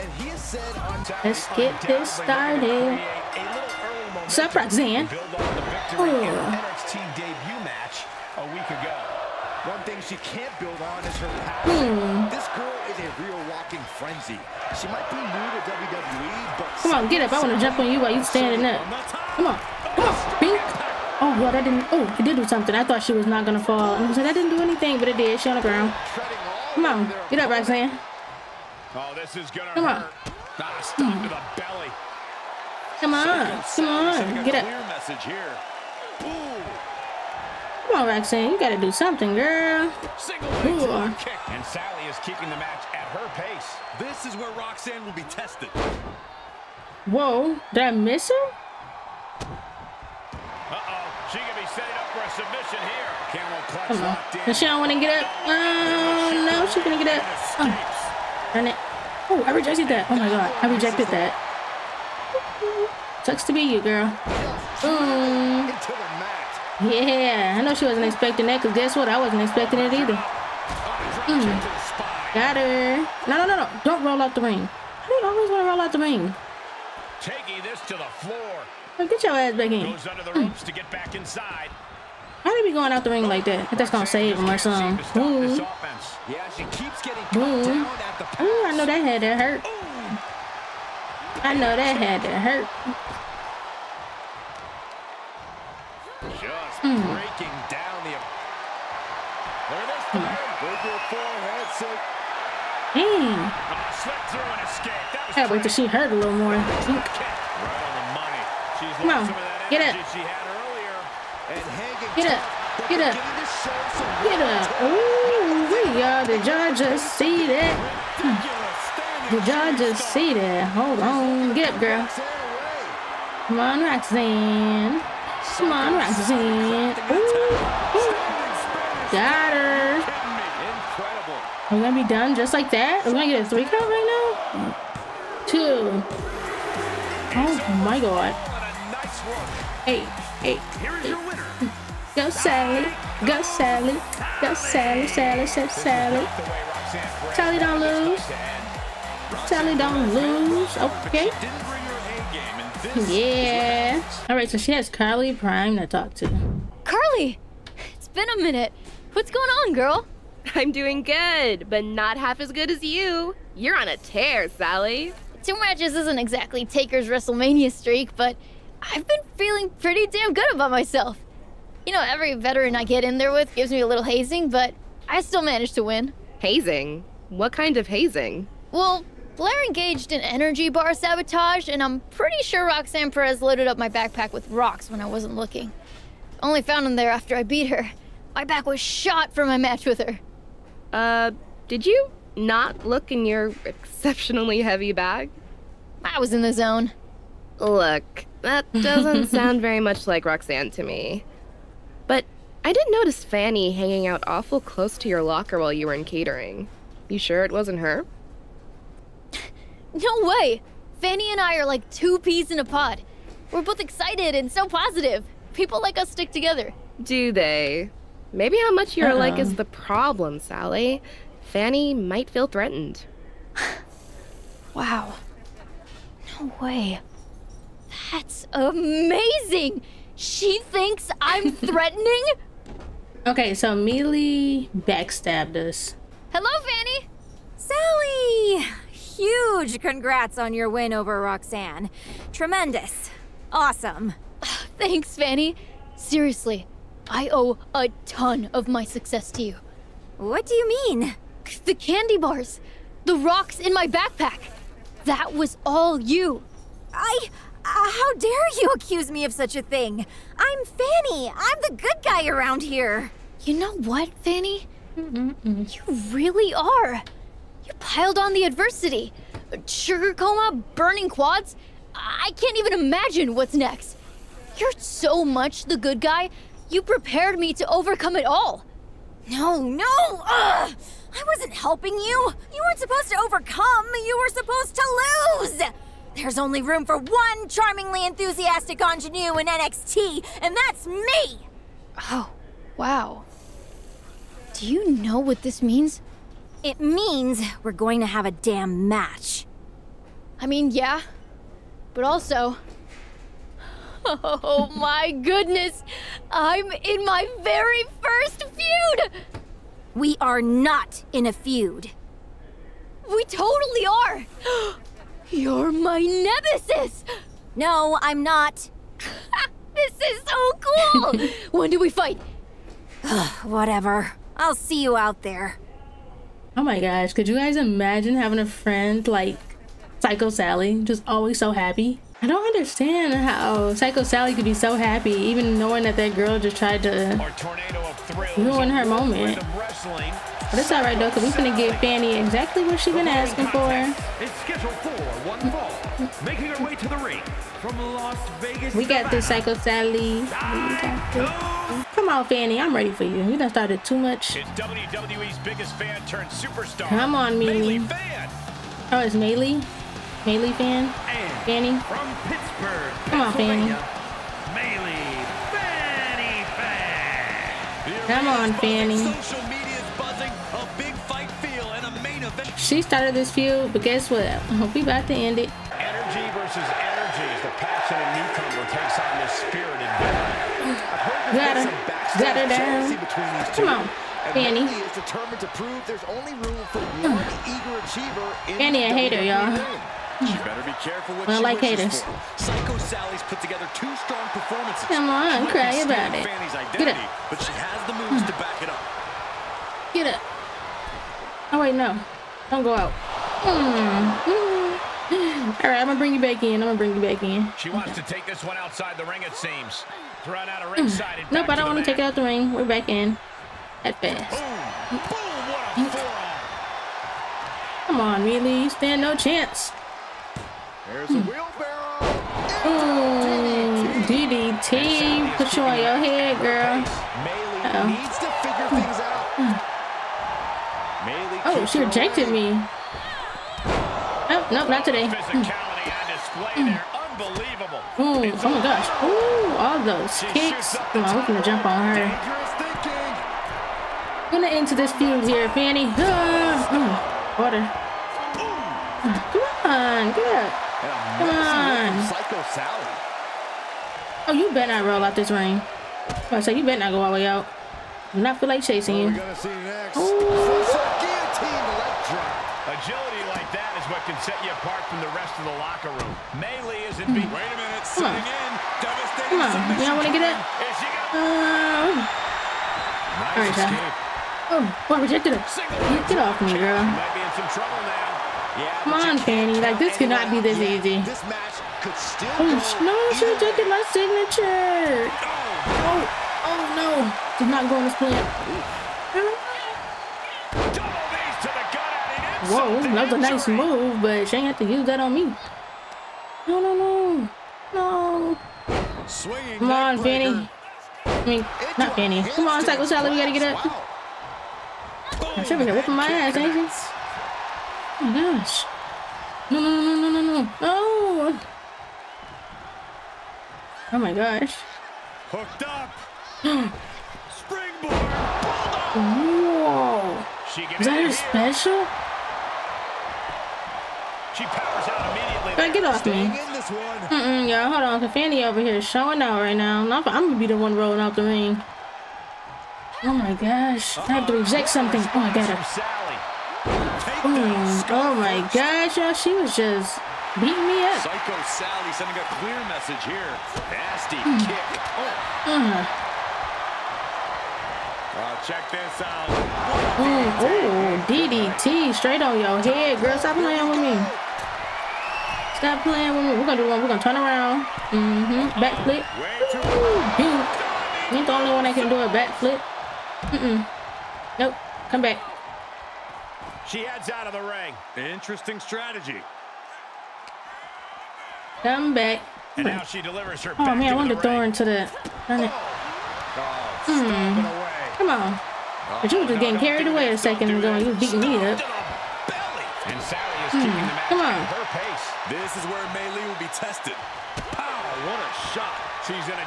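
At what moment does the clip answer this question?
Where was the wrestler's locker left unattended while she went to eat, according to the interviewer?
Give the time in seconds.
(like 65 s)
206 s.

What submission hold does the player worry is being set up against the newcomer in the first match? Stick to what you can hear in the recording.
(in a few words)
Camel clutch.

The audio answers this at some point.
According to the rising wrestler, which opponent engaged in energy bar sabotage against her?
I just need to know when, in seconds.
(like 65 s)
179 s.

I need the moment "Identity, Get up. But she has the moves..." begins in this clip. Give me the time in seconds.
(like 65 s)
396 s.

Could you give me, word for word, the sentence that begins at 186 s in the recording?
Only found them there after I beat her.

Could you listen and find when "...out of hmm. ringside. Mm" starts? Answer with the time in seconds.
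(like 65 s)
410 s.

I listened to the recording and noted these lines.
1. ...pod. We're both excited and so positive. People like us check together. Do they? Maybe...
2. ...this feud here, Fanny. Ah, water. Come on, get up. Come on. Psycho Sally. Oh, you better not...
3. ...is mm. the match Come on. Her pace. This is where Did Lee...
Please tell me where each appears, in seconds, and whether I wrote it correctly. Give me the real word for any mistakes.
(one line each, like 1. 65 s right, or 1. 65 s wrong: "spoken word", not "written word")
1. 212 s wrong: "stick", not "check"
2. 444 s right
3. 583 s wrong: "Mei", not "Did".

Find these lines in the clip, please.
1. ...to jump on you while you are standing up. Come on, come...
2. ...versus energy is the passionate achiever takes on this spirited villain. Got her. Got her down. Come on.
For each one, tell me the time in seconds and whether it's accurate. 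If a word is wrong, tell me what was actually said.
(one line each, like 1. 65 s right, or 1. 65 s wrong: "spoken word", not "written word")
1. 17 s right
2. 376 s wrong: "newcomer", not "achiever".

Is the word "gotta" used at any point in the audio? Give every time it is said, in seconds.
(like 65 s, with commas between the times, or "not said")
38 s, 503 s.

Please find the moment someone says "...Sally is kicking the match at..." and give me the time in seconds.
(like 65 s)
41 s.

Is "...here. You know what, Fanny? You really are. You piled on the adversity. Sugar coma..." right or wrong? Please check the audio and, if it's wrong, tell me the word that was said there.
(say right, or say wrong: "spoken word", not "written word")
right.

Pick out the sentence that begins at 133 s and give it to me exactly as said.
We're gonna get a three count right now?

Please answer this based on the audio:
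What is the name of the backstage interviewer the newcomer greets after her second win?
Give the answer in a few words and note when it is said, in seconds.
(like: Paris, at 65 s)
Carly Prime, at 154 s.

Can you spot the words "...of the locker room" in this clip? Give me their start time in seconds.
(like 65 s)
465 s.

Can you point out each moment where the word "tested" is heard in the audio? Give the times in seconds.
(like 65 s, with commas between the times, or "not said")
45 s, 586 s.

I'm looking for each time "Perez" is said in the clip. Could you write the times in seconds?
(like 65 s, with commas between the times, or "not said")
183 s.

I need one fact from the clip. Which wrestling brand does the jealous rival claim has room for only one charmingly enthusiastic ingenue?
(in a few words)
NXT.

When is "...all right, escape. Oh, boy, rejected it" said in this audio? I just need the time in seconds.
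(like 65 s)
473 s.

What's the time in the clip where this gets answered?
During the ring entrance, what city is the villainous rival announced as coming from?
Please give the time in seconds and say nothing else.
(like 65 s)
362 s.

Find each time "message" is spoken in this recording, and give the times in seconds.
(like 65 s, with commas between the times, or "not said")
34 s, 542 s.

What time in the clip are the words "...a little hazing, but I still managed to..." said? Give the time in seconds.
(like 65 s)
173 s.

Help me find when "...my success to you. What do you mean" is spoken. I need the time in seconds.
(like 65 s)
248 s.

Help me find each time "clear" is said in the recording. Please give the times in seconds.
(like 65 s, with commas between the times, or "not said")
542 s.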